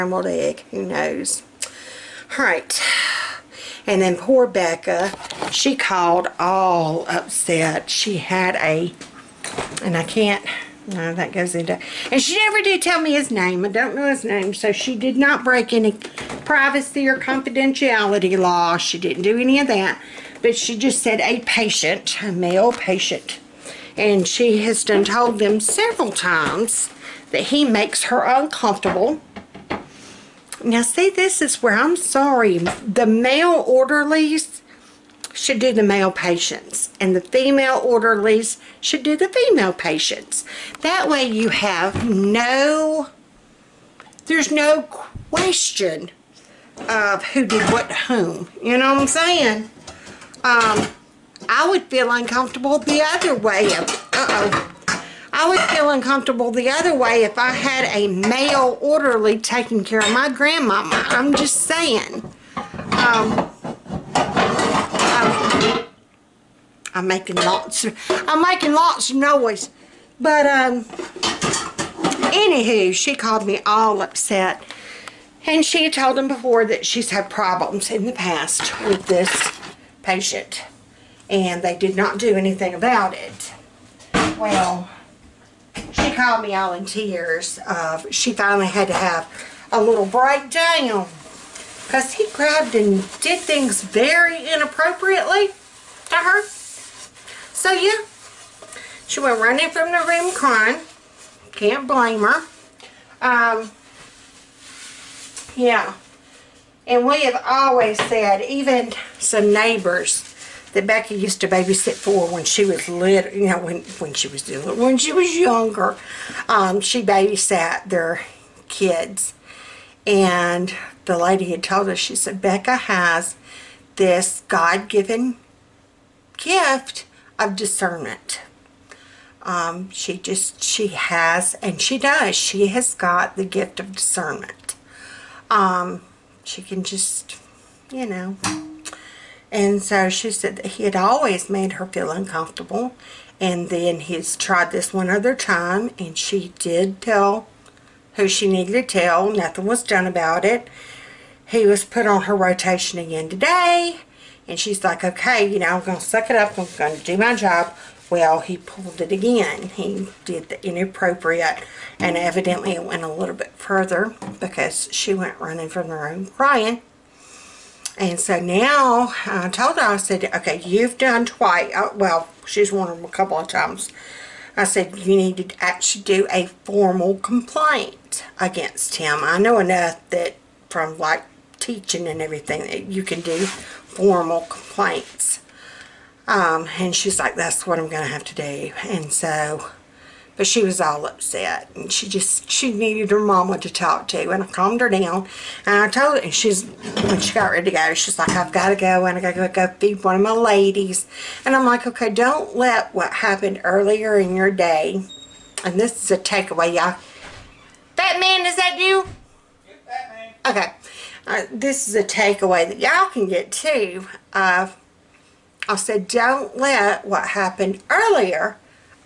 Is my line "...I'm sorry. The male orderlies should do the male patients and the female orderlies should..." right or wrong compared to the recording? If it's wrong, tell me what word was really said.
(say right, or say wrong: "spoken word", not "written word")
right.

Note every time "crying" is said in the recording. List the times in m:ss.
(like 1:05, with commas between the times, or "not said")
1:40, 2:46.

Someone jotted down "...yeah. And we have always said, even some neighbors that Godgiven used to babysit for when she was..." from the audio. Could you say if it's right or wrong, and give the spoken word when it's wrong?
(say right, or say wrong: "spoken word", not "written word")
wrong: "Becky", not "Godgiven".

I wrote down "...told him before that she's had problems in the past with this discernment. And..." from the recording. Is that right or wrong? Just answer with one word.
wrong.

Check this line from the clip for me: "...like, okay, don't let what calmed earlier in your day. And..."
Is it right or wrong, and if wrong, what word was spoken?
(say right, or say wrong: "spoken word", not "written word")
wrong: "happened", not "calmed".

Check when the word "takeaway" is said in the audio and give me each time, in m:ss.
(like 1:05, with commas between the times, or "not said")
3:26, 3:32.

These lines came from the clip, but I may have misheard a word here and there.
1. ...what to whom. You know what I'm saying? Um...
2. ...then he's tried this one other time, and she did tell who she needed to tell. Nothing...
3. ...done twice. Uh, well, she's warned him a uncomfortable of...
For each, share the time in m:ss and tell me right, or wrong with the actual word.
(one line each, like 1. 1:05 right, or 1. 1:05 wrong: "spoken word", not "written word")
1. 0:47 right
2. 2:23 right
3. 2:50 wrong: "couple", not "uncomfortable".